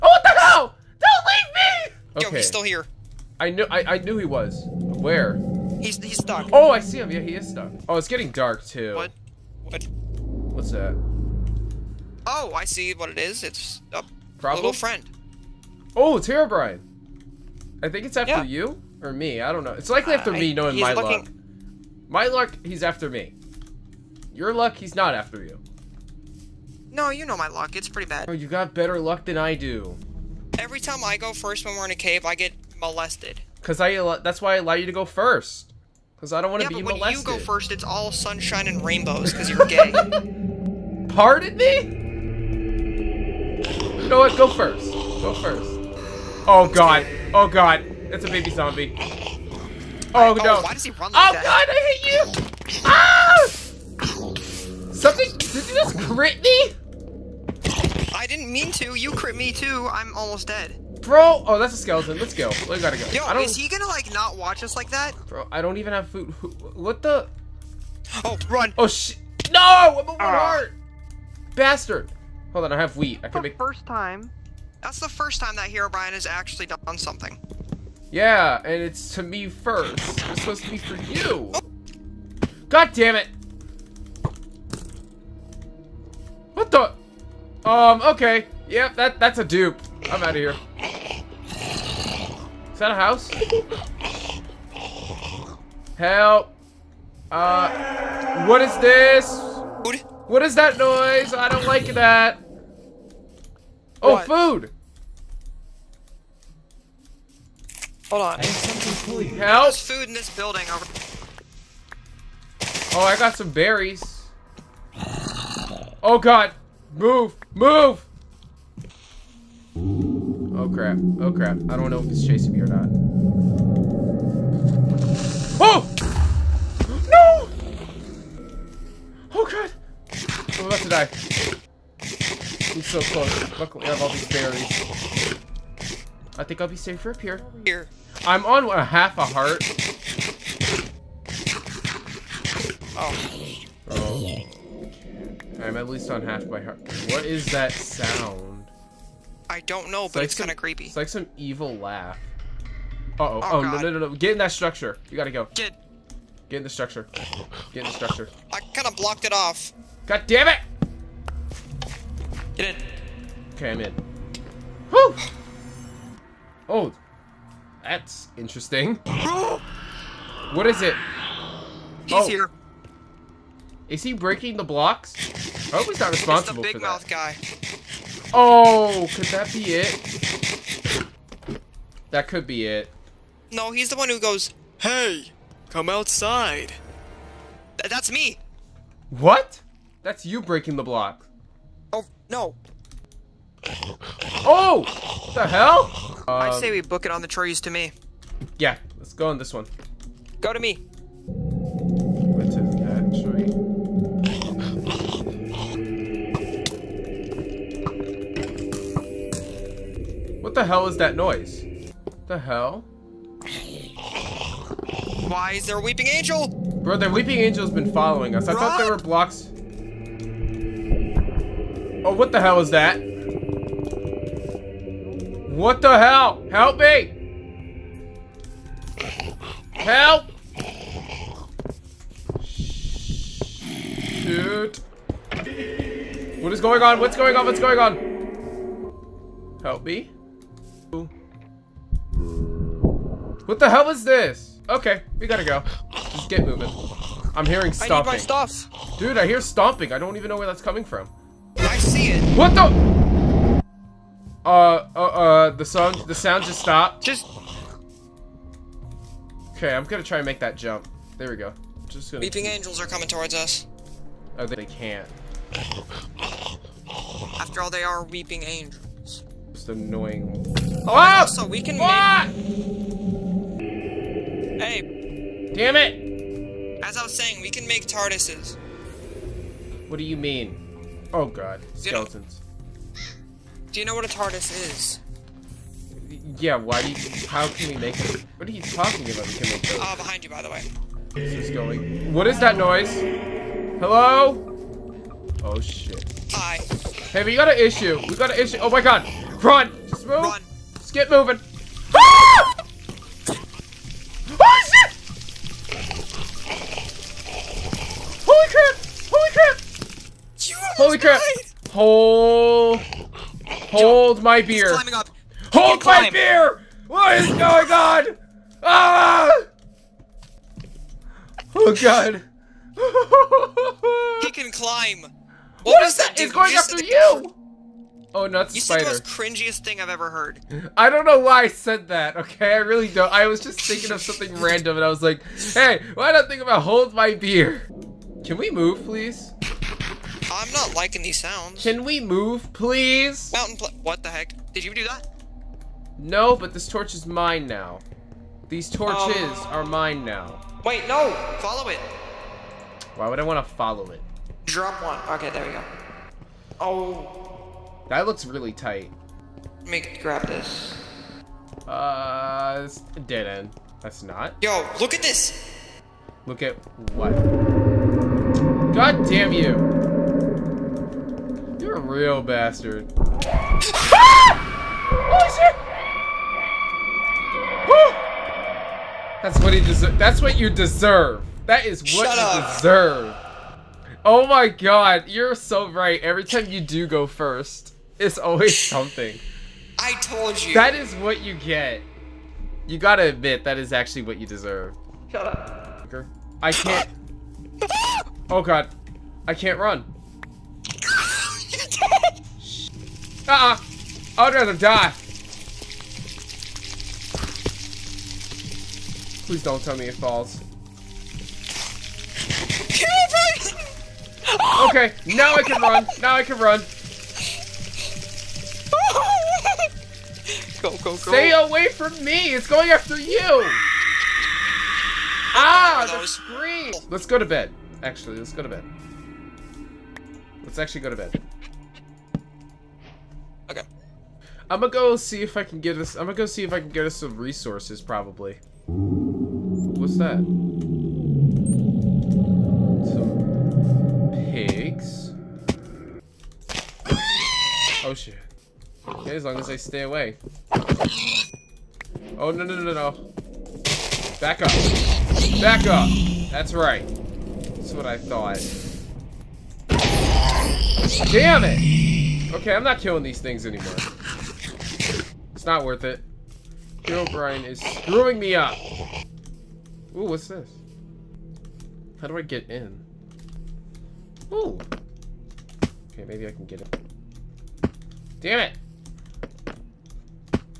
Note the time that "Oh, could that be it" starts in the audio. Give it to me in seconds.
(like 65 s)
178 s.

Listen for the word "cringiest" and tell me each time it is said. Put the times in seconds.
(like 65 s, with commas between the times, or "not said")
329 s.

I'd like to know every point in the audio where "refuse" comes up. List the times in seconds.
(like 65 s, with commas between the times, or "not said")
not said.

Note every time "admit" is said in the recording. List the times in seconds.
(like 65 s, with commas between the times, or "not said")
393 s.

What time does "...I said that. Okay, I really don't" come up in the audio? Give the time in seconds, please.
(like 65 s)
331 s.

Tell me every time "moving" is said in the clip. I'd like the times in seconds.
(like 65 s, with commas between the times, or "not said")
246 s, 301 s.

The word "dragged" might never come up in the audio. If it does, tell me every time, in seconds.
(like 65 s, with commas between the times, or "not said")
not said.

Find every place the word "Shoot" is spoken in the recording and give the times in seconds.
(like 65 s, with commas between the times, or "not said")
232 s.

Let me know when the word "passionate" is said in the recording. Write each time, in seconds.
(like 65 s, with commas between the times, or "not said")
not said.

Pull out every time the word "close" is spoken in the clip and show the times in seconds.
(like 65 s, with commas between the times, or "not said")
133 s.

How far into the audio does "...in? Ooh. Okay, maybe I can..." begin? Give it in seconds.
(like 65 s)
472 s.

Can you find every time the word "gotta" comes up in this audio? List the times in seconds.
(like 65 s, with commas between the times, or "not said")
62 s, 155 s, 245 s, 392 s.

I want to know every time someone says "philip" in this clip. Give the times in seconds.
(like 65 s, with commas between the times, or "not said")
not said.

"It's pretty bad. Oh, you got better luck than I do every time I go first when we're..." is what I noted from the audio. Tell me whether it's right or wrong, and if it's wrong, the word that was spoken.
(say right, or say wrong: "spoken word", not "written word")
right.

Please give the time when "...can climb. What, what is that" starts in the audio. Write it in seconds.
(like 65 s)
324 s.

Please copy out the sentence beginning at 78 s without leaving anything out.
Yeah, and it's to me first.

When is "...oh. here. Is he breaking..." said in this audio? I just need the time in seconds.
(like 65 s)
172 s.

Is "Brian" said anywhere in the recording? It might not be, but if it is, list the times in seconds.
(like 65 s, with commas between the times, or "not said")
16 s, 467 s.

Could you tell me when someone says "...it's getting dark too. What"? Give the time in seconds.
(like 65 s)
7 s.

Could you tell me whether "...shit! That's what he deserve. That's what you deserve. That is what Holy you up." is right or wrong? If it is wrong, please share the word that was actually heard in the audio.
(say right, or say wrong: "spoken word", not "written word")
wrong: "Shut", not "Holy".